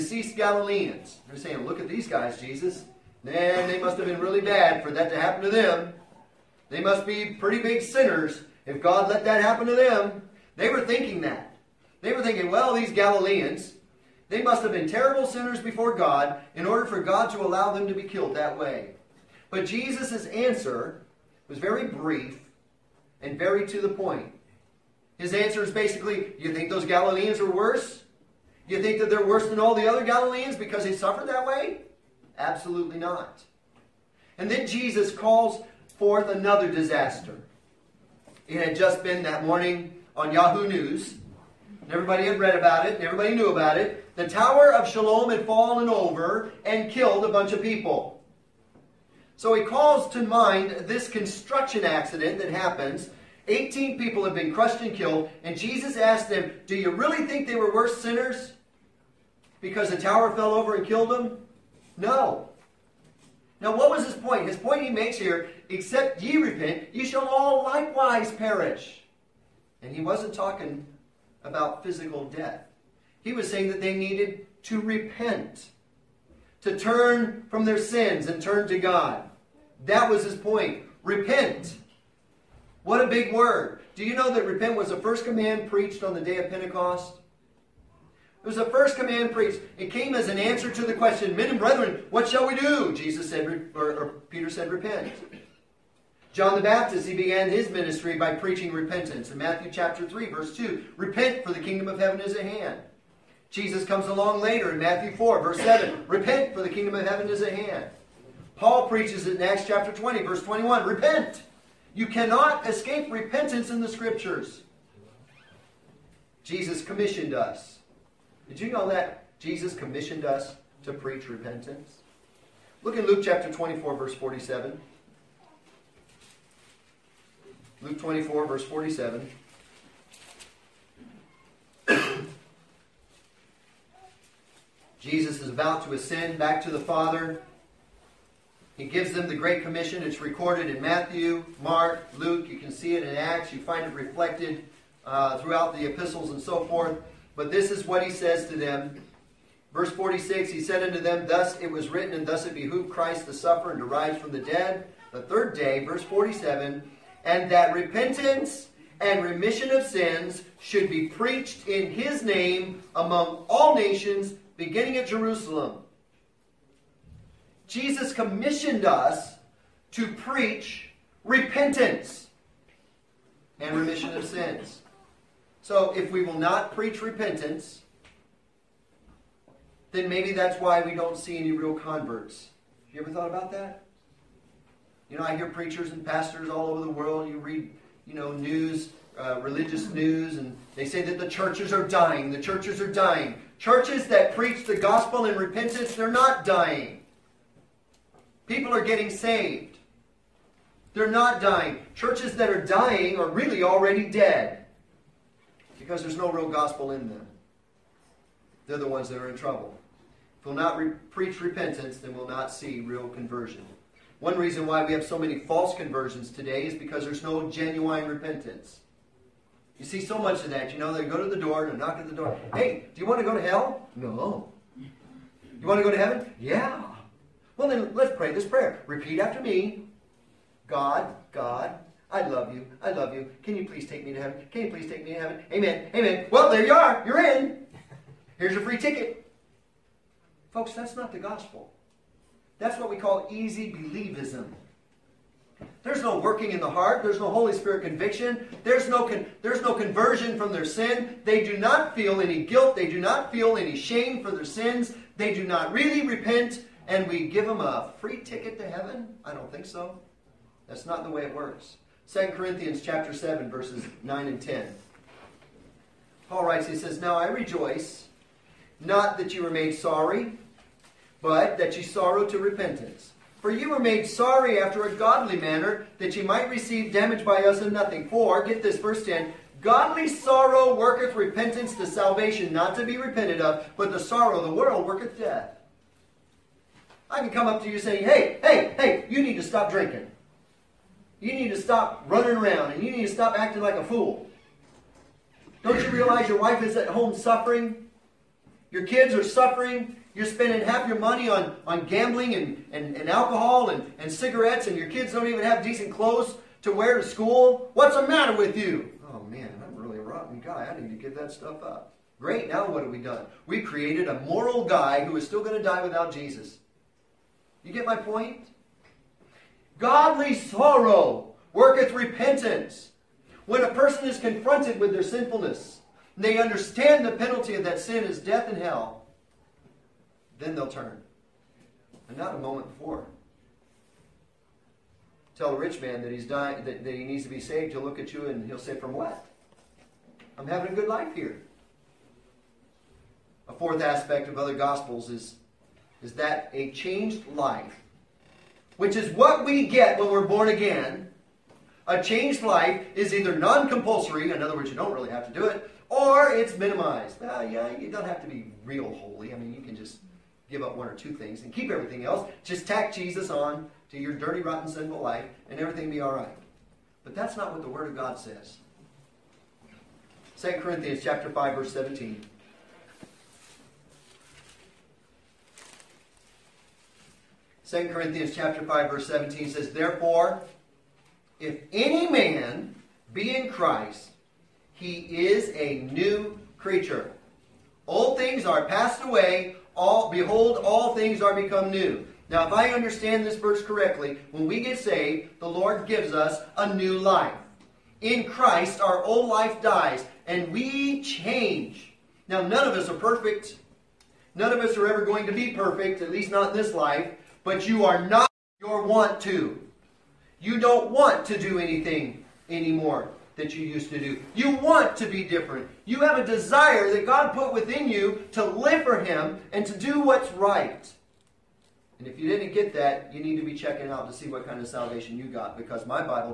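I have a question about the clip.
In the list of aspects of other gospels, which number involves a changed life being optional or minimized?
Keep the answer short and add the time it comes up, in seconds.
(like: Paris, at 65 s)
Fourth, at 343 s.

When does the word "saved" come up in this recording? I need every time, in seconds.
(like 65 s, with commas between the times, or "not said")
199 s, 337 s, 394 s.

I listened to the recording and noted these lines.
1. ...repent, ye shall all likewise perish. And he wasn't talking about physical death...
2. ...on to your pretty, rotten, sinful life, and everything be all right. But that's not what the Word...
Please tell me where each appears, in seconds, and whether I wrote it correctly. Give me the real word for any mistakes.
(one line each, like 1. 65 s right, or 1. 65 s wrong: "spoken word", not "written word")
1. 66 s right
2. 363 s wrong: "dirty", not "pretty".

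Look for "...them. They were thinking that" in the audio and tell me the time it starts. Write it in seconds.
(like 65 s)
9 s.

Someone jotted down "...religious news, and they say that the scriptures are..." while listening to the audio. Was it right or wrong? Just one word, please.
wrong.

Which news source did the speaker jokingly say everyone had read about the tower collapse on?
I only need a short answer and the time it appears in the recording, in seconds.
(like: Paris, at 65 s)
Yahoo News, at 40 s.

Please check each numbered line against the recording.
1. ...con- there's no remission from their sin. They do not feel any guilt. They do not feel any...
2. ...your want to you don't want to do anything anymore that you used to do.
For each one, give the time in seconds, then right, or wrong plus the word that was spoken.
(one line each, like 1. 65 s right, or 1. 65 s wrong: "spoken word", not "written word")
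1. 249 s wrong: "conversion", not "remission"
2. 408 s right.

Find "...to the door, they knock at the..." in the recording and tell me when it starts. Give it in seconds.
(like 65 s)
221 s.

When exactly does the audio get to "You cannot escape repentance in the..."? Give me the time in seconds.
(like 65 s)
111 s.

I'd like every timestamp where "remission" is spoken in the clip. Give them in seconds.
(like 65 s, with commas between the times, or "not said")
159 s, 173 s.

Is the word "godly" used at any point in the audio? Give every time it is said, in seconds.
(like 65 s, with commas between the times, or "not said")
274 s, 279 s, 319 s.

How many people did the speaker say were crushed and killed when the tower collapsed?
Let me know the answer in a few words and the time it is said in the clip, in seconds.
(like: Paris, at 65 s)
18, at 53 s.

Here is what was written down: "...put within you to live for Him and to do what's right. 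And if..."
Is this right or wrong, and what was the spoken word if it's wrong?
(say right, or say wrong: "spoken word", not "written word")
right.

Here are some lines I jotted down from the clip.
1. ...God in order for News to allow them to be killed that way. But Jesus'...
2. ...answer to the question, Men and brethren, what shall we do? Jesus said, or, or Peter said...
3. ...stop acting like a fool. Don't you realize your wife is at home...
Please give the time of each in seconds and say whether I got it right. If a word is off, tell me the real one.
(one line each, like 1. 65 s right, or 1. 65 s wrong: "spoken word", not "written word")
1. 15 s wrong: "God", not "News"
2. 90 s right
3. 293 s right.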